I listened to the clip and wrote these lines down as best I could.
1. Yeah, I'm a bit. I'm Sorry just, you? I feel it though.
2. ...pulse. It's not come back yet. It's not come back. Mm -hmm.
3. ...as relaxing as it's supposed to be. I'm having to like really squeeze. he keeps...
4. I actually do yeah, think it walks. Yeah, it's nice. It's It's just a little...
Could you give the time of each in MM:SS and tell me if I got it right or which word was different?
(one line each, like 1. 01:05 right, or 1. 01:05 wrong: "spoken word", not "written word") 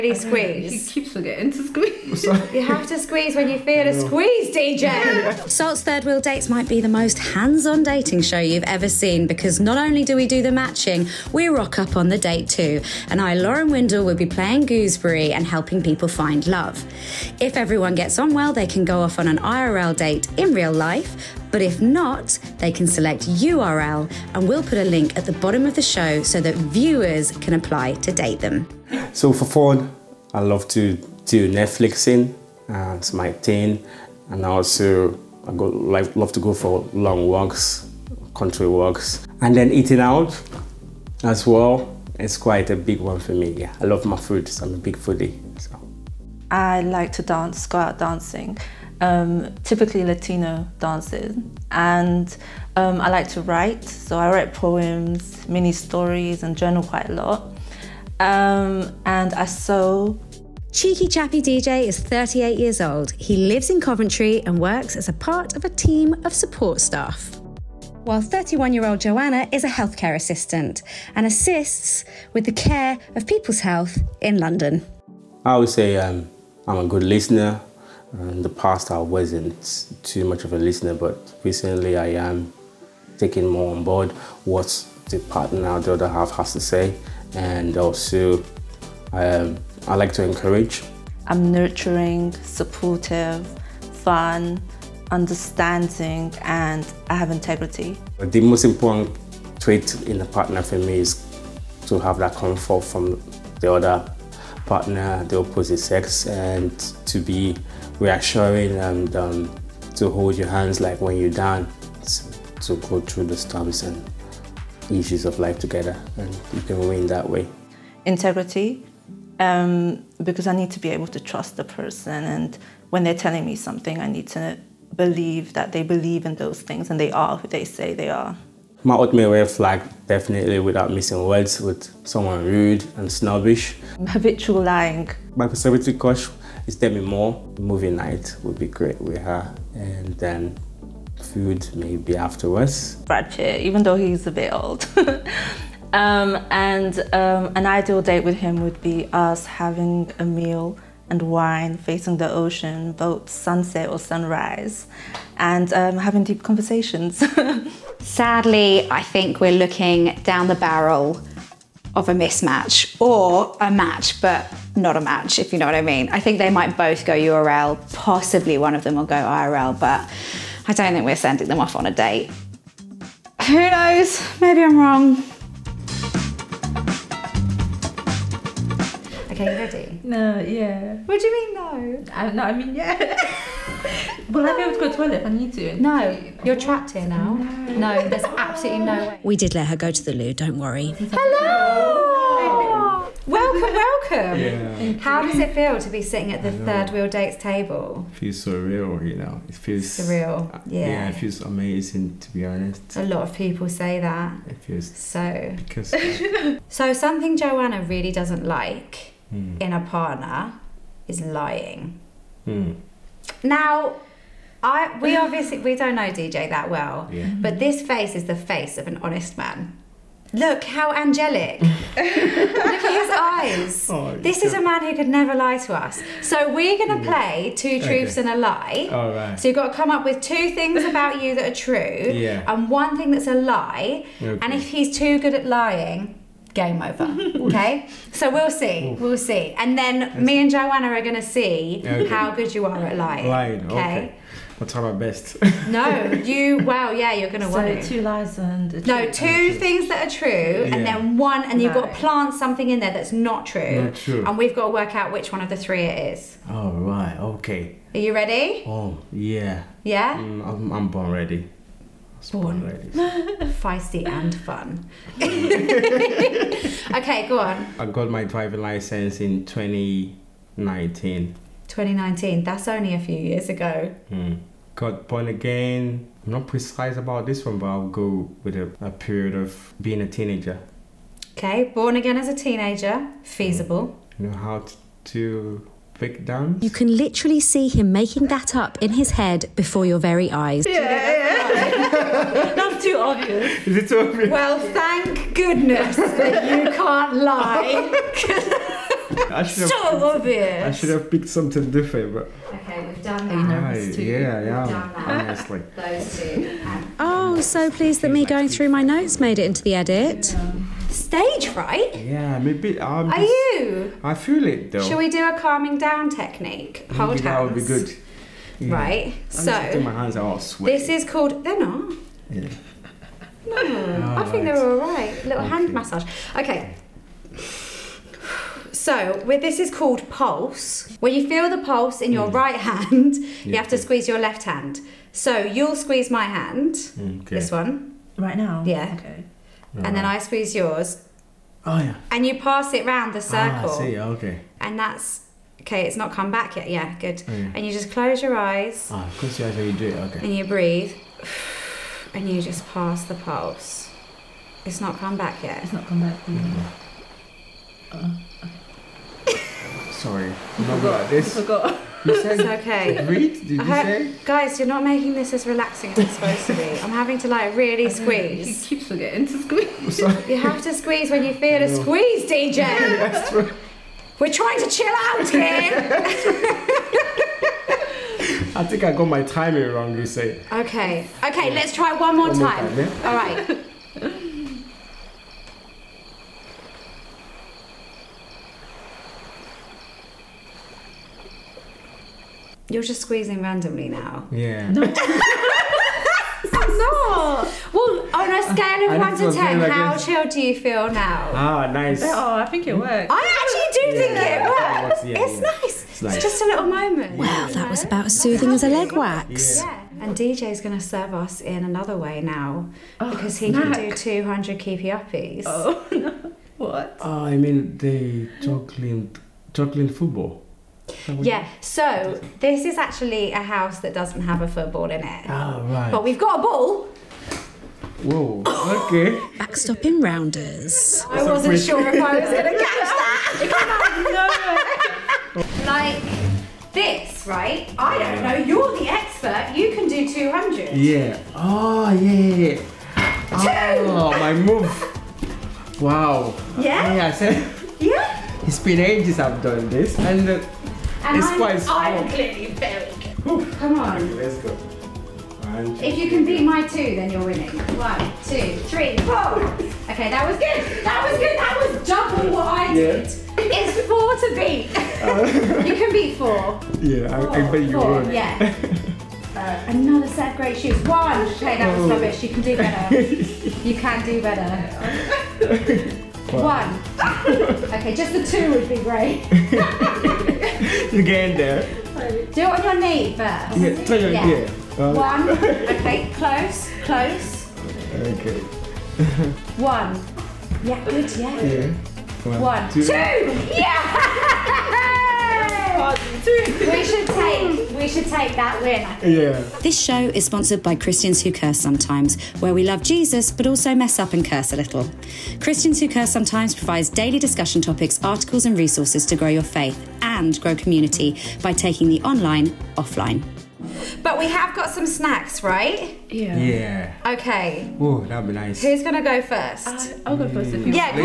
1. 05:11 wrong: "Are", not "Sorry"
2. 05:53 right
3. 06:05 right
4. 06:43 wrong: "works", not "walks".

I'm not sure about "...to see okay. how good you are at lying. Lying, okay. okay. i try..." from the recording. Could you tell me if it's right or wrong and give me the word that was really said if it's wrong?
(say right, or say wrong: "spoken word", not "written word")
right.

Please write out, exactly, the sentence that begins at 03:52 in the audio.
and one thing that's a lie.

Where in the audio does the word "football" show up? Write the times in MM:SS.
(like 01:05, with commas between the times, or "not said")
06:59, 07:04.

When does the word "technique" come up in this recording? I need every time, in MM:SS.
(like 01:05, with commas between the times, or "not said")
05:16.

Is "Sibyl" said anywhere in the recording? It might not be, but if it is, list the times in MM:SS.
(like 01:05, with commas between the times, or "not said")
not said.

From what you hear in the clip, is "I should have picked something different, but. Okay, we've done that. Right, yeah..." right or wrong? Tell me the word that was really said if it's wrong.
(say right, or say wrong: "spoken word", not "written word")
right.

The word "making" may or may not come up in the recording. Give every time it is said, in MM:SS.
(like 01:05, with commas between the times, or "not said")
04:47, 06:04.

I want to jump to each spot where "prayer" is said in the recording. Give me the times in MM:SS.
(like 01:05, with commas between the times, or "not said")
not said.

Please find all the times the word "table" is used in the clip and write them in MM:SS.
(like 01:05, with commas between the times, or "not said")
03:17.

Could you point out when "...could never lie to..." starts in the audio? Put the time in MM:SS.
03:44.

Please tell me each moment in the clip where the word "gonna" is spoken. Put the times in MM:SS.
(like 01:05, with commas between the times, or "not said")
04:07, 08:38.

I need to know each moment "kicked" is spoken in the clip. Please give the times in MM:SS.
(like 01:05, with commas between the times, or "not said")
not said.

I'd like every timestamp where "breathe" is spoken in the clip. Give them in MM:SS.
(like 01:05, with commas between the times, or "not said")
05:50.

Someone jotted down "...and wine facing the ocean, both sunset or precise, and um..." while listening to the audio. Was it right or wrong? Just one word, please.
wrong.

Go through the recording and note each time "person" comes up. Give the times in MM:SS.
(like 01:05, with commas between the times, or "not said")
02:01.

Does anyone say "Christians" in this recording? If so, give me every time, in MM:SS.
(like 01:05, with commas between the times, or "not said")
08:20, 08:25.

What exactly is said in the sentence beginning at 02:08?
My ultimate red flag, definitely without missing words, with someone rude and snobbish.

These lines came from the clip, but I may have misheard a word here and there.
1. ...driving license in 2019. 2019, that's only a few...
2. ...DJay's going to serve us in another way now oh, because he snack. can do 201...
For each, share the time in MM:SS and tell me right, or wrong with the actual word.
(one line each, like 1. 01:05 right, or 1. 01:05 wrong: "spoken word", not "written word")
1. 04:28 right
2. 06:50 wrong: "200", not "201".